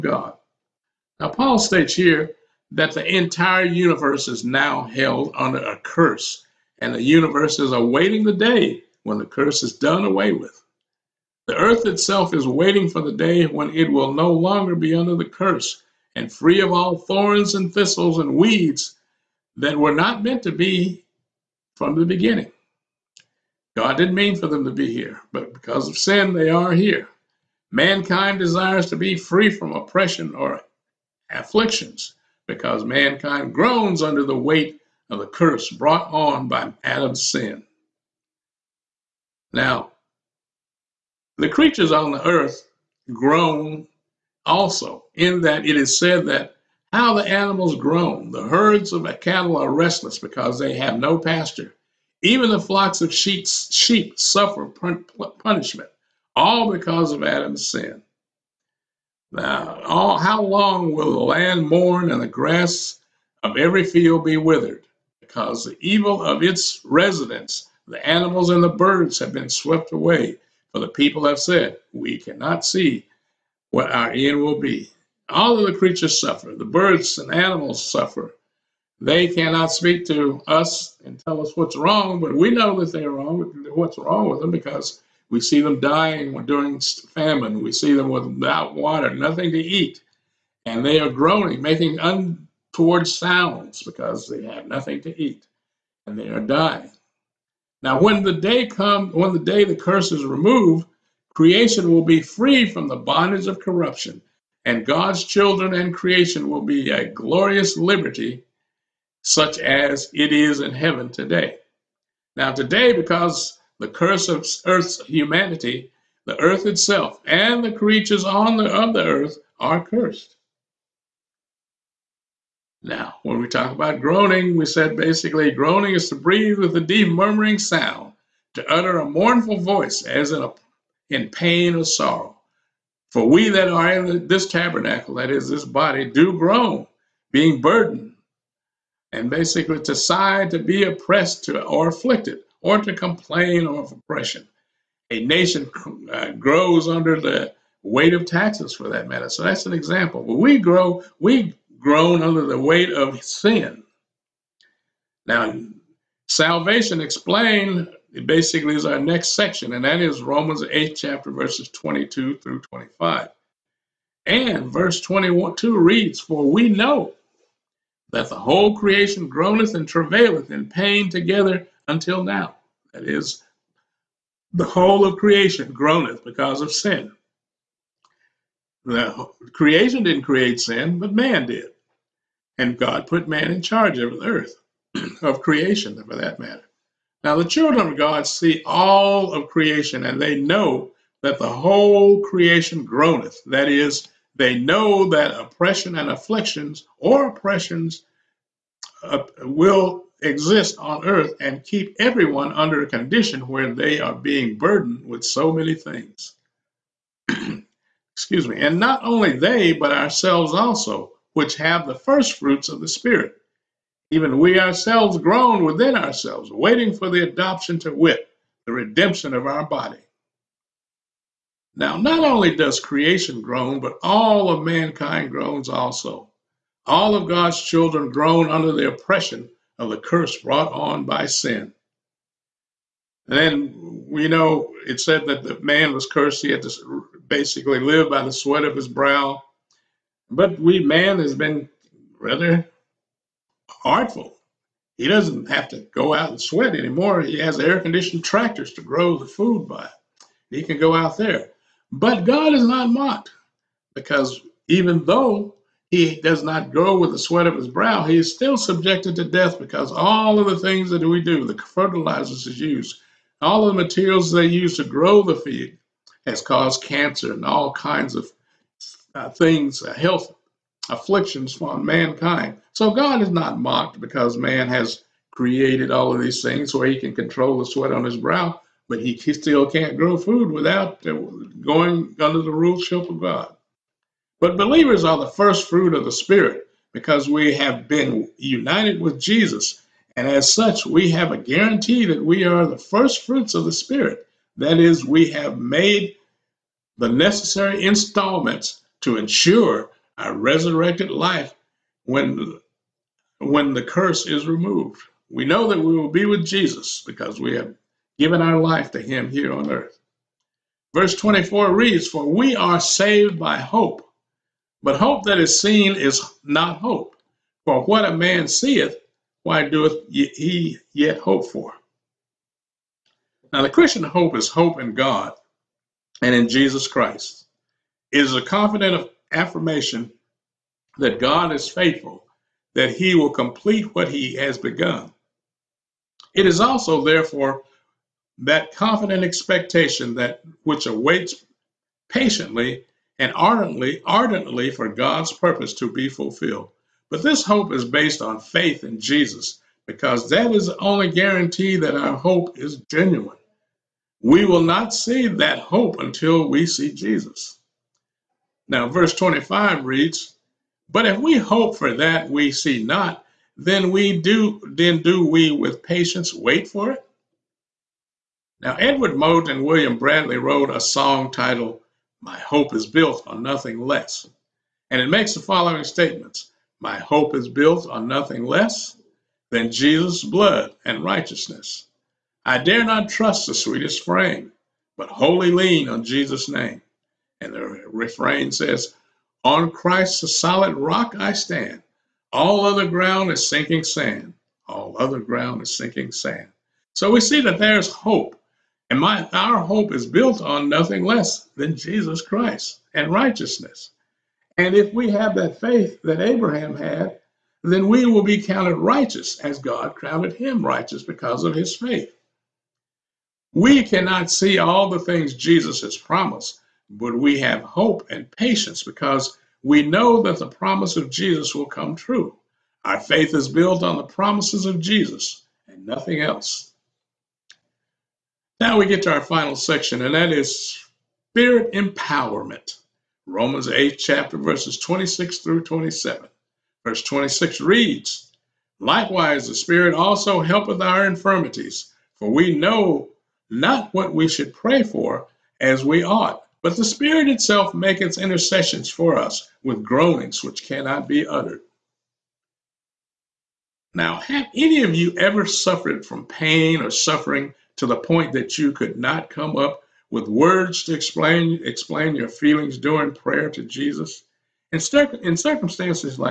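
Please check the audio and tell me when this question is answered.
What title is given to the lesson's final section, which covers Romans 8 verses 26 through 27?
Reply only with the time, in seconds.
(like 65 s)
431 s.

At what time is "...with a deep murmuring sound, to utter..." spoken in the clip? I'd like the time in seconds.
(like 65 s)
126 s.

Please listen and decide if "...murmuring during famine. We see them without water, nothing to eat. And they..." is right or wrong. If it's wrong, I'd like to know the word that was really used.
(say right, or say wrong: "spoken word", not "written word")
wrong: "dying", not "murmuring".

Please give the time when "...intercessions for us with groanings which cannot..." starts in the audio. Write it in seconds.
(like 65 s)
448 s.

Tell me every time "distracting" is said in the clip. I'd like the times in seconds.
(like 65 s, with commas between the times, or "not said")
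not said.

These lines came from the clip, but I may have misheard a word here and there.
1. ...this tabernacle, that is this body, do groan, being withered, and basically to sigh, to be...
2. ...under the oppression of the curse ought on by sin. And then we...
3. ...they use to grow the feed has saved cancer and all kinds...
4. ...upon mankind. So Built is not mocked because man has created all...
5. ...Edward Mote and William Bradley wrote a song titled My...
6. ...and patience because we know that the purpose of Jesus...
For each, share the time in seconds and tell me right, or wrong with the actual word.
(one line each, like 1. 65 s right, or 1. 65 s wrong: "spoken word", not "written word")
1. 134 s wrong: "burdened", not "withered"
2. 228 s wrong: "brought", not "ought"
3. 264 s wrong: "caused", not "saved"
4. 271 s wrong: "God", not "Built"
5. 368 s right
6. 418 s wrong: "promise", not "purpose".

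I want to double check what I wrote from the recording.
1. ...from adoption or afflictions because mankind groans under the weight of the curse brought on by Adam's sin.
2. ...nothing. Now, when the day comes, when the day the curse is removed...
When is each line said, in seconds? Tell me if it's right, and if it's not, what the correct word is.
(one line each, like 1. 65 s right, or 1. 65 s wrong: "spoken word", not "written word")
1. 29 s wrong: "oppression", not "adoption"
2. 96 s wrong: "dying", not "nothing".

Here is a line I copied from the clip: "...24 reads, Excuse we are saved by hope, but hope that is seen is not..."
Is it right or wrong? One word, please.
wrong.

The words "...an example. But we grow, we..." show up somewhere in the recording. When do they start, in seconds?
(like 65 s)
149 s.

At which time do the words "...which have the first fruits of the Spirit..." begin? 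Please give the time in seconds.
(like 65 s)
211 s.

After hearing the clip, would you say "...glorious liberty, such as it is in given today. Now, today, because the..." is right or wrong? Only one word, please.
wrong.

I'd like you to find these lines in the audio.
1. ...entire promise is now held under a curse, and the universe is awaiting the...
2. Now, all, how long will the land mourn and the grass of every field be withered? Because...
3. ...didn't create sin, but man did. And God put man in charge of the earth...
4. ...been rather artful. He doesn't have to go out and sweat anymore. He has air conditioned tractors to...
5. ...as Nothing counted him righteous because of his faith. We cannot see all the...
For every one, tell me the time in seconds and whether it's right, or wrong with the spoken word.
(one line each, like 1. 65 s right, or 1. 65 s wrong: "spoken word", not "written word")
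1. 3 s wrong: "universe", not "promise"
2. 59 s right
3. 180 s right
4. 241 s right
5. 409 s wrong: "God", not "Nothing".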